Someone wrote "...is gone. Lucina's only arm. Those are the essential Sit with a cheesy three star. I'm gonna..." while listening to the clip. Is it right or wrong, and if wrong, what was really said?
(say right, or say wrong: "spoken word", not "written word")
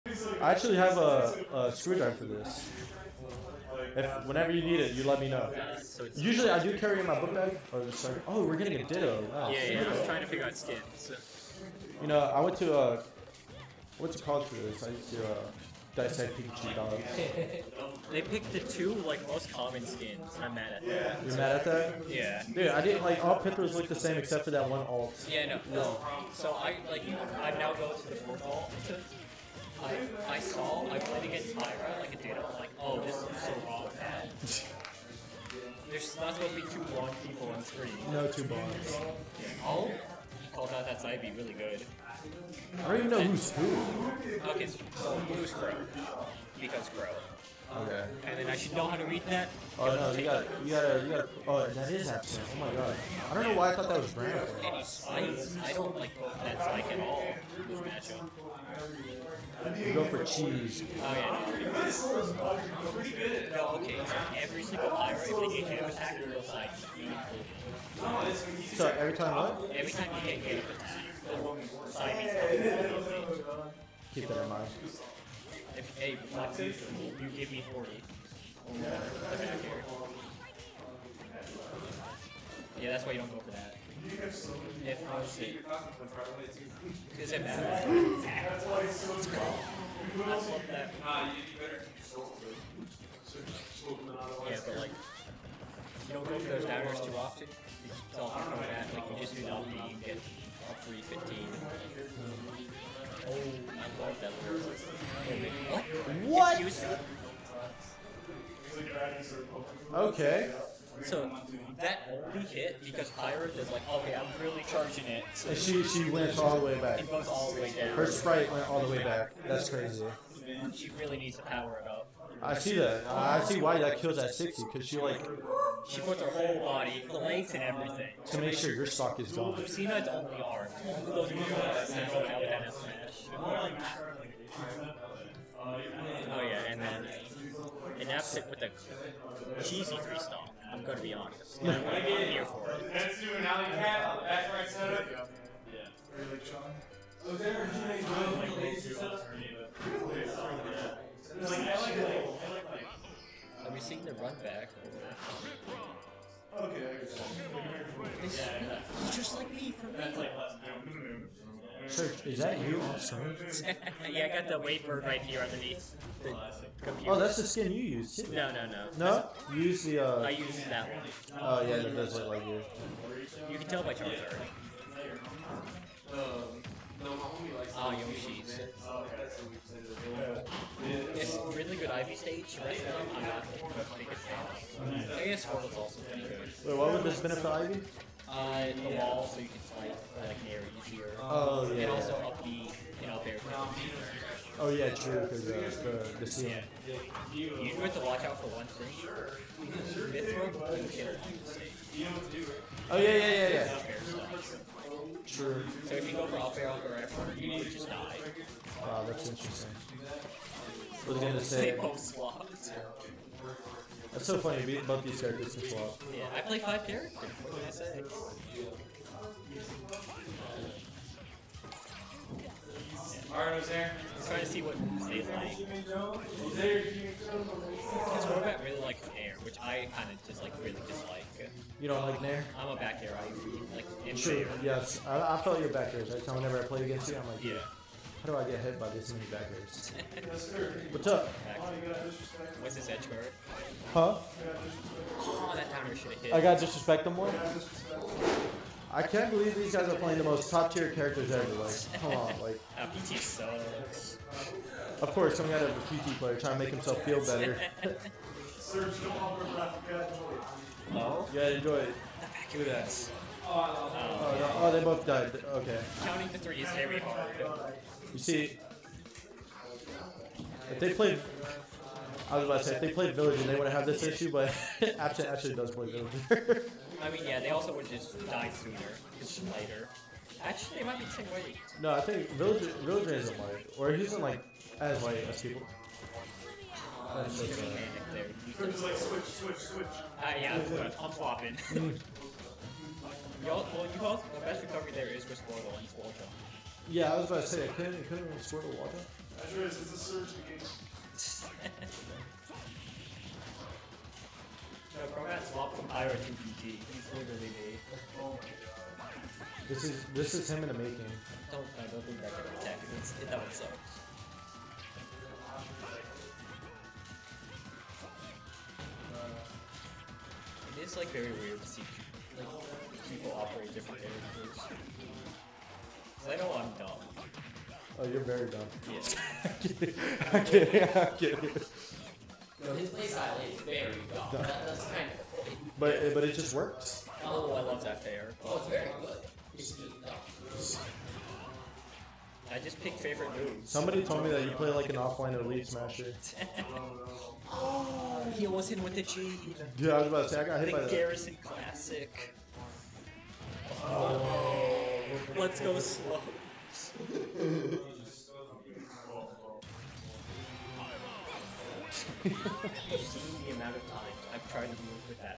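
right.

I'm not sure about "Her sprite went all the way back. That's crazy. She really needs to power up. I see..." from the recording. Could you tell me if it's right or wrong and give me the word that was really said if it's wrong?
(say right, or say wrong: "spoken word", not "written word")
right.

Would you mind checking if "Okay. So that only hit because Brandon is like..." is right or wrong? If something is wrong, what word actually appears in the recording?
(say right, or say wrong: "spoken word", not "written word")
wrong: "Pyra", not "Brandon".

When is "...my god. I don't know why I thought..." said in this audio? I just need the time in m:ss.
0:52.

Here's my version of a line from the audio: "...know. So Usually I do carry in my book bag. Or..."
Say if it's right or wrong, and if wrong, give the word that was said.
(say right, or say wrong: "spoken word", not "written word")
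right.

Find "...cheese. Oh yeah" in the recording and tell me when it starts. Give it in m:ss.
1:00.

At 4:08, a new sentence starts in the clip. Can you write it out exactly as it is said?
I can't believe these guys are playing the most top tier characters ever.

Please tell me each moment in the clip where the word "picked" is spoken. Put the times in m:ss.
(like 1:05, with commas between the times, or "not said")
0:18, 5:42.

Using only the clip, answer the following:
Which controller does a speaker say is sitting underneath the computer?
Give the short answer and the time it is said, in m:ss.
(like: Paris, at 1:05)
WaveBird, at 2:44.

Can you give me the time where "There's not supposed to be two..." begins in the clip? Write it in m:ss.
0:35.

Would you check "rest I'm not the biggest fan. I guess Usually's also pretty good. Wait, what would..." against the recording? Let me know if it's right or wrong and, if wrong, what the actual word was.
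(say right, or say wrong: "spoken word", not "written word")
wrong: "Squirtle", not "Usually".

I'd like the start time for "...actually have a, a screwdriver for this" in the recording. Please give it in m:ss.
0:00.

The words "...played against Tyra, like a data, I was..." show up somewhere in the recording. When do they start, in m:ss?
0:30.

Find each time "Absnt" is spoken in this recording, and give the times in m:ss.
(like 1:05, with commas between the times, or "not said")
0:52, 4:34.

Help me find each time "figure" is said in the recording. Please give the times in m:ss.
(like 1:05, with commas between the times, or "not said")
0:10.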